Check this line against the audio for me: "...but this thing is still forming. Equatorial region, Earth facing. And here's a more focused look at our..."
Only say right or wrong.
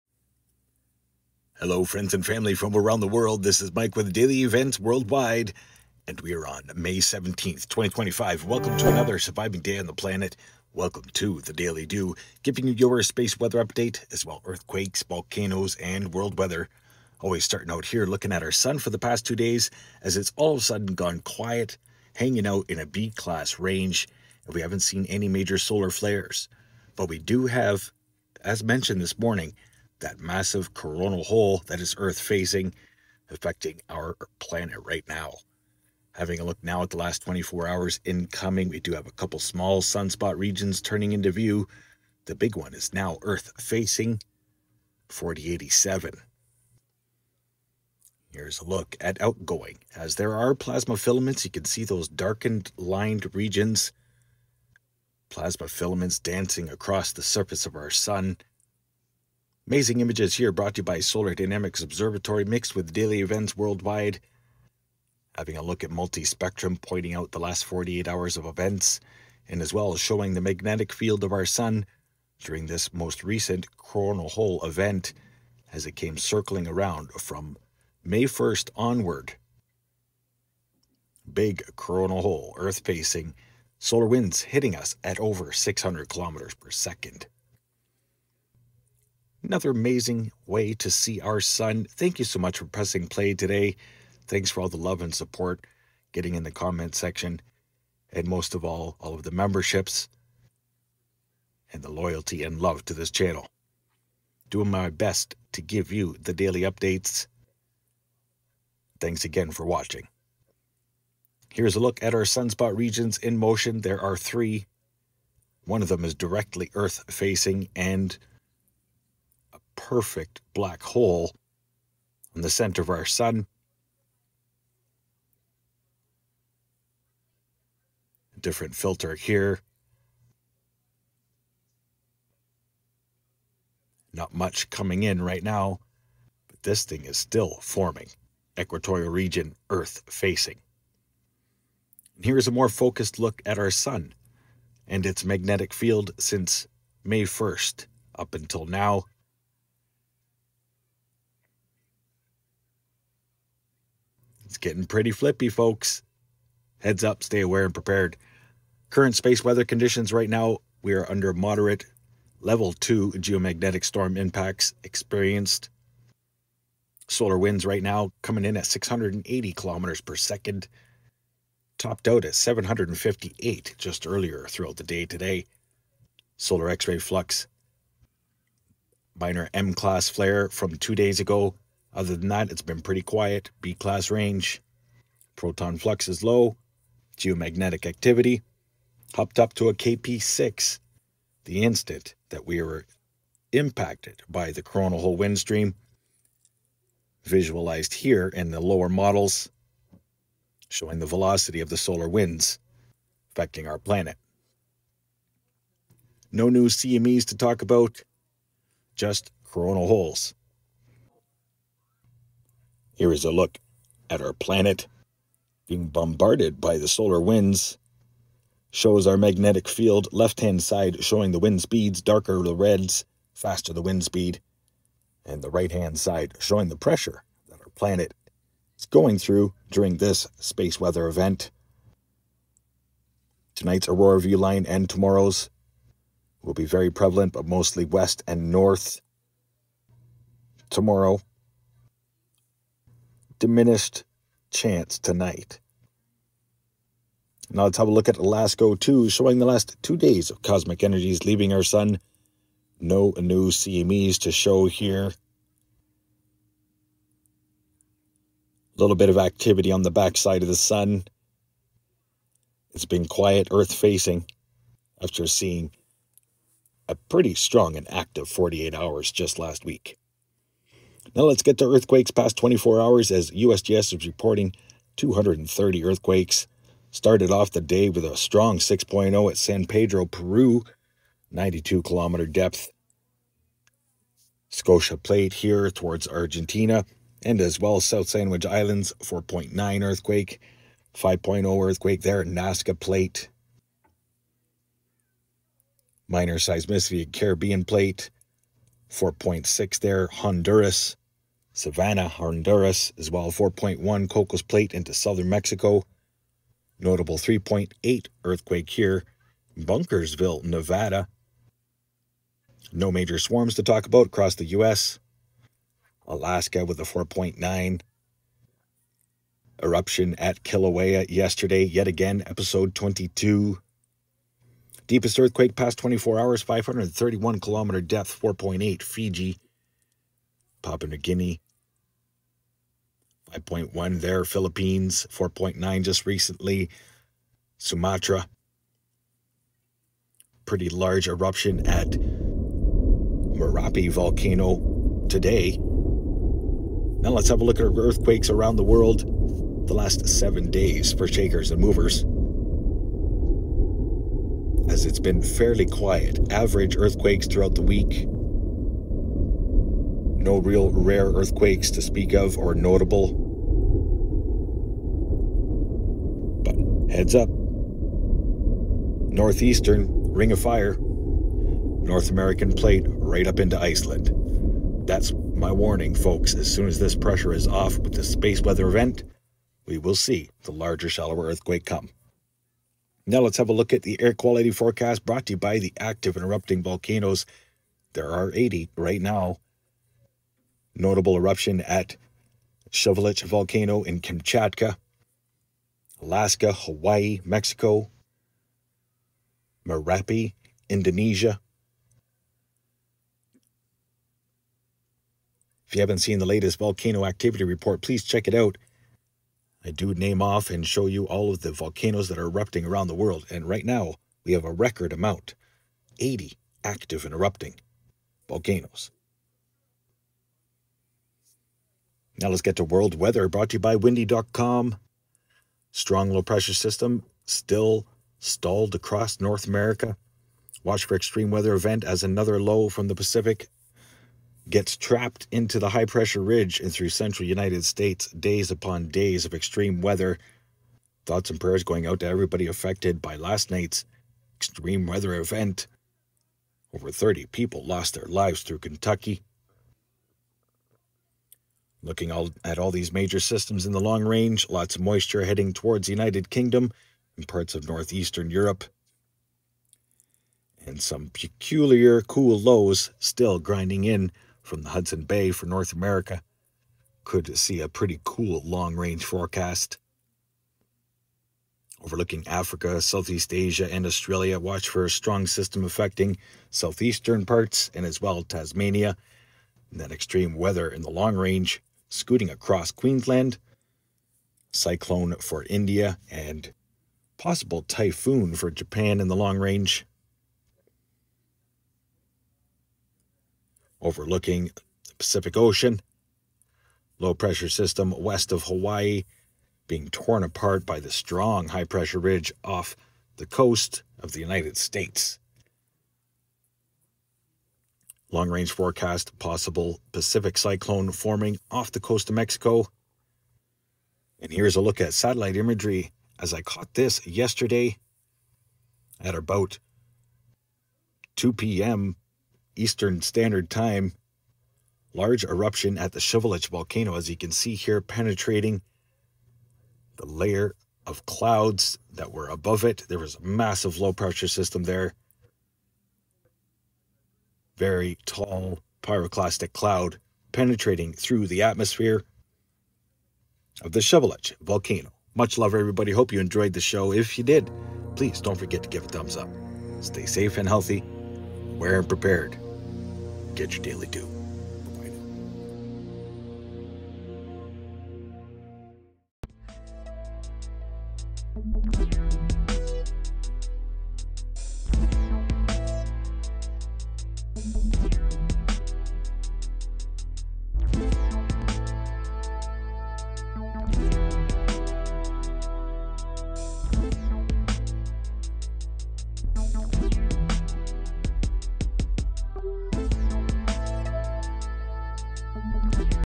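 right.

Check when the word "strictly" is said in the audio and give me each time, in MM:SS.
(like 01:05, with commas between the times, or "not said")
not said.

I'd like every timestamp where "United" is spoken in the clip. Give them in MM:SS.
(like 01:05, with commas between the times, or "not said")
07:17, 07:35, 08:24.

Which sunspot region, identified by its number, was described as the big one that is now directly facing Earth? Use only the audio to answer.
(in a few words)
4087.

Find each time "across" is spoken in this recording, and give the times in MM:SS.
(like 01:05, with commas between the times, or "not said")
00:56, 05:14, 07:08, 08:02.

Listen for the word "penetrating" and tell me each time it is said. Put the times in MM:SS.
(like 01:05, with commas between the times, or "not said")
08:47, 09:00.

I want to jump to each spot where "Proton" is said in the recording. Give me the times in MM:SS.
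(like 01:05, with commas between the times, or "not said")
03:05.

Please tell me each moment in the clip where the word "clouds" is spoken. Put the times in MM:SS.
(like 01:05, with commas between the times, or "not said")
08:51, 08:59.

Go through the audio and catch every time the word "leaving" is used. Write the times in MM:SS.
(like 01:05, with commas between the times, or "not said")
04:11.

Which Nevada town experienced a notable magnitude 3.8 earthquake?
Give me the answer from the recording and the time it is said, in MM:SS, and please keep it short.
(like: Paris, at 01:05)
Bunkersville, at 05:09.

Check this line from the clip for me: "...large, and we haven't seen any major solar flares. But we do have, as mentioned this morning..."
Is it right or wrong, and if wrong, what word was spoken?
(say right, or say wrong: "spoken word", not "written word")
wrong: "range", not "large".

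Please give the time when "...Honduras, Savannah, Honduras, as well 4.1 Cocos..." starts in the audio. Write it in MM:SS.
05:00.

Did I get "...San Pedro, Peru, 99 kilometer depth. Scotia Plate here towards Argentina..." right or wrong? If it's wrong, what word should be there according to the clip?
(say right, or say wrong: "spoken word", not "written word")
wrong: "92", not "99".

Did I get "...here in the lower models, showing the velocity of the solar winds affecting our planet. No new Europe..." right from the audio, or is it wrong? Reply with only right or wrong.
wrong.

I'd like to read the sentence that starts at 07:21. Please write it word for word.
Thoughts and prayers going out to everybody affected by last night's extreme weather event.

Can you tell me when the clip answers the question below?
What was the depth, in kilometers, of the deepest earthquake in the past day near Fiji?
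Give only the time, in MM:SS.
05:26.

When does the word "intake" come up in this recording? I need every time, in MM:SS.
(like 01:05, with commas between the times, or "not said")
not said.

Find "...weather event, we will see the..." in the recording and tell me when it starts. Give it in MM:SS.
06:18.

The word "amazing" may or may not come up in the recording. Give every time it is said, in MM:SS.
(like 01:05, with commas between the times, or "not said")
00:59, 01:29.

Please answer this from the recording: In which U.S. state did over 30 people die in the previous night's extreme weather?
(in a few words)
Kentucky.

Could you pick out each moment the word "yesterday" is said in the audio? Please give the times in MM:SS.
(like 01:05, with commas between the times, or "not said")
05:21, 08:37.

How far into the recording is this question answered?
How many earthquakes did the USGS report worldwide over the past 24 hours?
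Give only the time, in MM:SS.
04:34.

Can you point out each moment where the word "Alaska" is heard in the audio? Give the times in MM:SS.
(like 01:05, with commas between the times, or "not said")
05:16, 06:36.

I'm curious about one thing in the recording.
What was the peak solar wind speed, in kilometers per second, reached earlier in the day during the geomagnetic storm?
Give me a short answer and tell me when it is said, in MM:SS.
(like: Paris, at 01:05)
758, at 02:52.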